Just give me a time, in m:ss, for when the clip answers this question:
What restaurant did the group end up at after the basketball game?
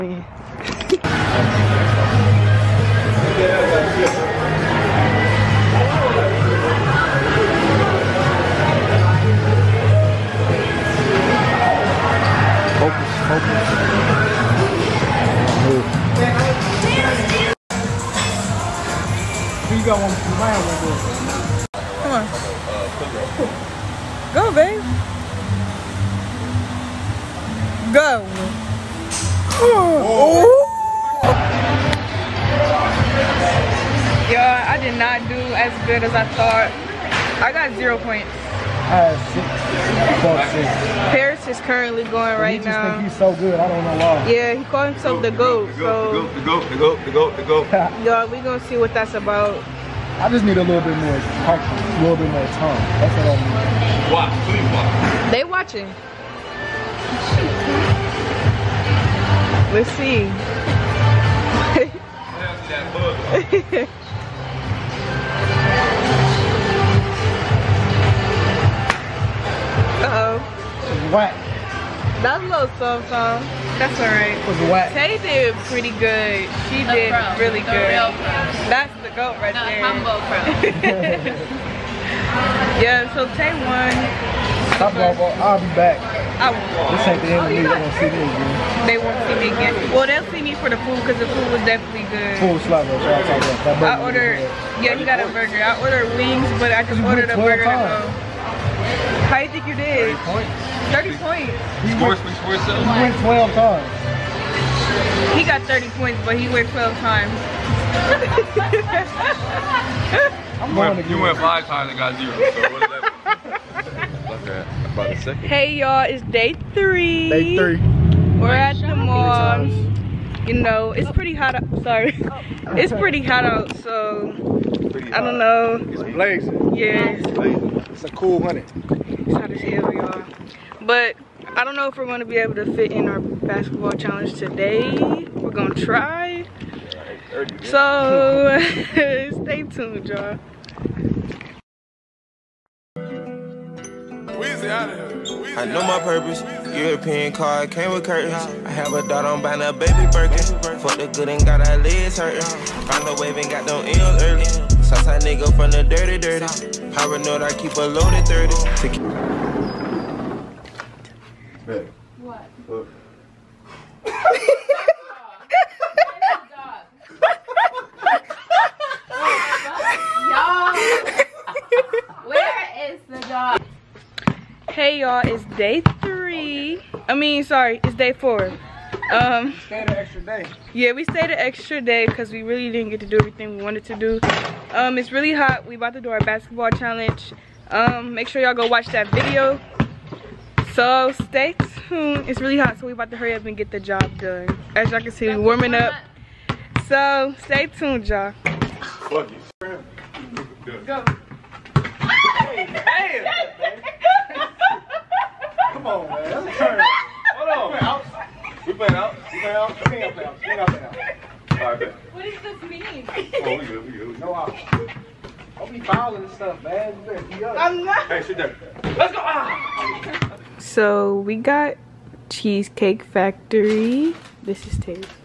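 3:42.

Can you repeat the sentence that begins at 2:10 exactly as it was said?
But I don't know if we're going to be able to fit in our basketball challenge today.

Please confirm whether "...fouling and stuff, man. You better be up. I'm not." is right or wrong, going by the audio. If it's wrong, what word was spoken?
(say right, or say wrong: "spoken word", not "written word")
right.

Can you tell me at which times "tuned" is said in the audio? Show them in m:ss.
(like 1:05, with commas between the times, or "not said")
2:19, 3:11, 3:17.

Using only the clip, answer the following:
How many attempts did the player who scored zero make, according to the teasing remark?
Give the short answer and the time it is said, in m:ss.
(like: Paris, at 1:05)
5, at 1:51.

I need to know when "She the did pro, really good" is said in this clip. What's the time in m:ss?
1:16.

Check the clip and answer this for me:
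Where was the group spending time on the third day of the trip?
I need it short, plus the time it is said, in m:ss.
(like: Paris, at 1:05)
The mall, at 1:58.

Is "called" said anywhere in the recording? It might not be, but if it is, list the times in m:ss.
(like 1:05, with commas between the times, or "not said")
0:44.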